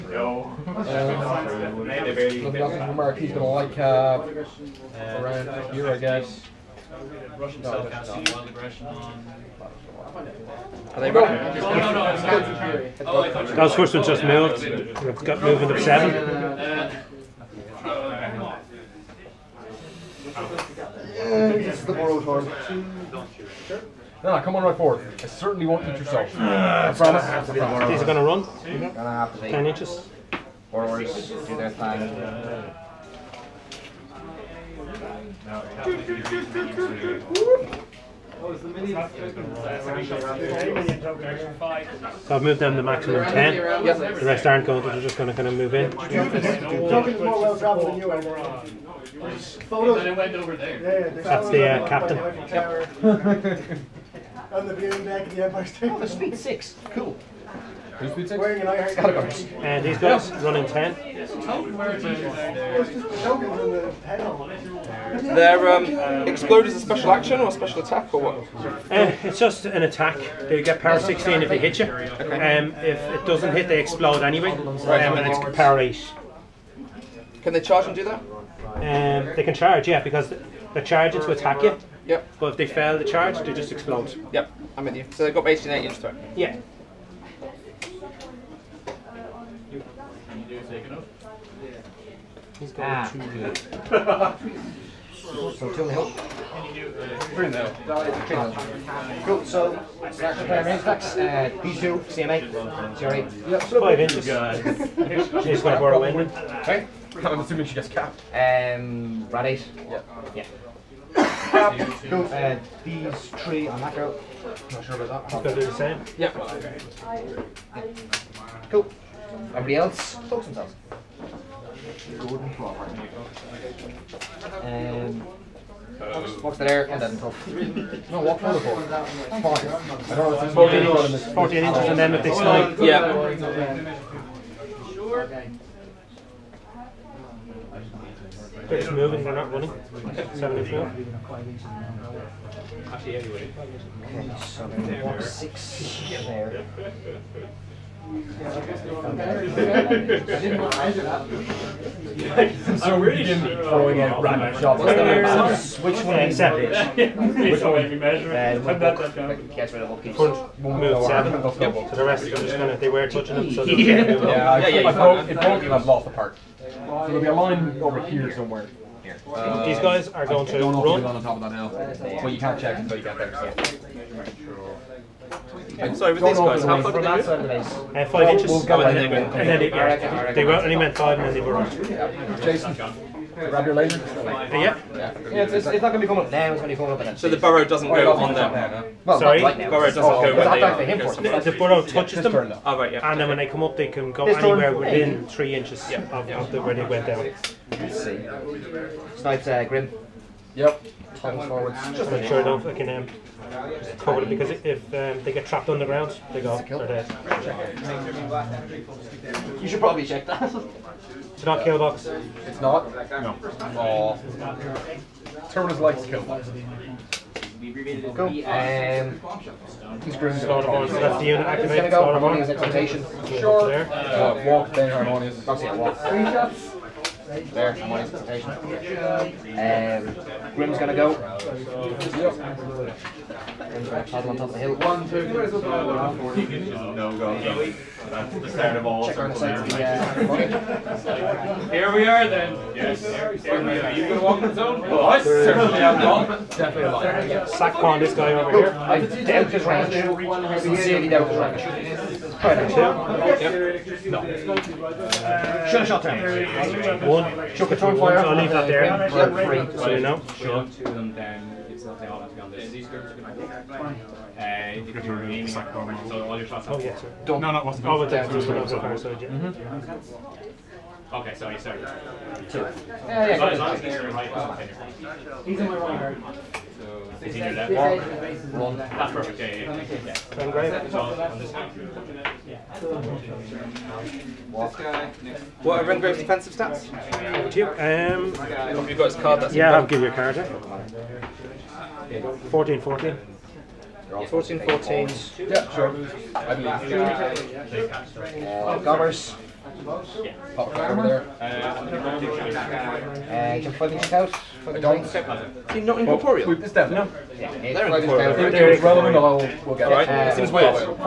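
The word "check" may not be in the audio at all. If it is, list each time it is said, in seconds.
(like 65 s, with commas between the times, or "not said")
172 s, 210 s, 239 s.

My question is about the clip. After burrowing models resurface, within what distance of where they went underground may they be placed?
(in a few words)
3 inches.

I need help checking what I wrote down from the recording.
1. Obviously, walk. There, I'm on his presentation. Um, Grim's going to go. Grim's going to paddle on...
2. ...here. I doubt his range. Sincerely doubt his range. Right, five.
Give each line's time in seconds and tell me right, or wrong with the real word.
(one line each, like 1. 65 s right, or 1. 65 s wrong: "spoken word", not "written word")
1. 225 s right
2. 248 s wrong: "two", not "five".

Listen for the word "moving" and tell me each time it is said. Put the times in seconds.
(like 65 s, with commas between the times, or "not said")
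15 s, 138 s.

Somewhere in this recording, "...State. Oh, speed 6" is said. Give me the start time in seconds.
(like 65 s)
55 s.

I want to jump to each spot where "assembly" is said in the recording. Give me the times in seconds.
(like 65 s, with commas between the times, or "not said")
not said.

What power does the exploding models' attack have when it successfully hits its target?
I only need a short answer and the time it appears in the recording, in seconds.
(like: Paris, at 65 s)
16, at 70 s.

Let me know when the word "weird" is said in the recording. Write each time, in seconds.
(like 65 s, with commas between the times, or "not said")
310 s.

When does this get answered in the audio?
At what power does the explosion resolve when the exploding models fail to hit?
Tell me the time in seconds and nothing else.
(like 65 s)
75 s.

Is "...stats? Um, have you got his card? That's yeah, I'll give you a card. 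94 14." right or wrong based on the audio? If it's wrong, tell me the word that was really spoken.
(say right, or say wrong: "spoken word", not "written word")
wrong: "14", not "94".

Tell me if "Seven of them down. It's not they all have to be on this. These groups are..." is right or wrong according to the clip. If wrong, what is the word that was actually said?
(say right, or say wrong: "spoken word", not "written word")
wrong: "Two", not "Seven".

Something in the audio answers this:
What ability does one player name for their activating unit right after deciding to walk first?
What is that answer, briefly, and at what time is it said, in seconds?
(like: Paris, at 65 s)
Harmonious Exaltation, at 222 s.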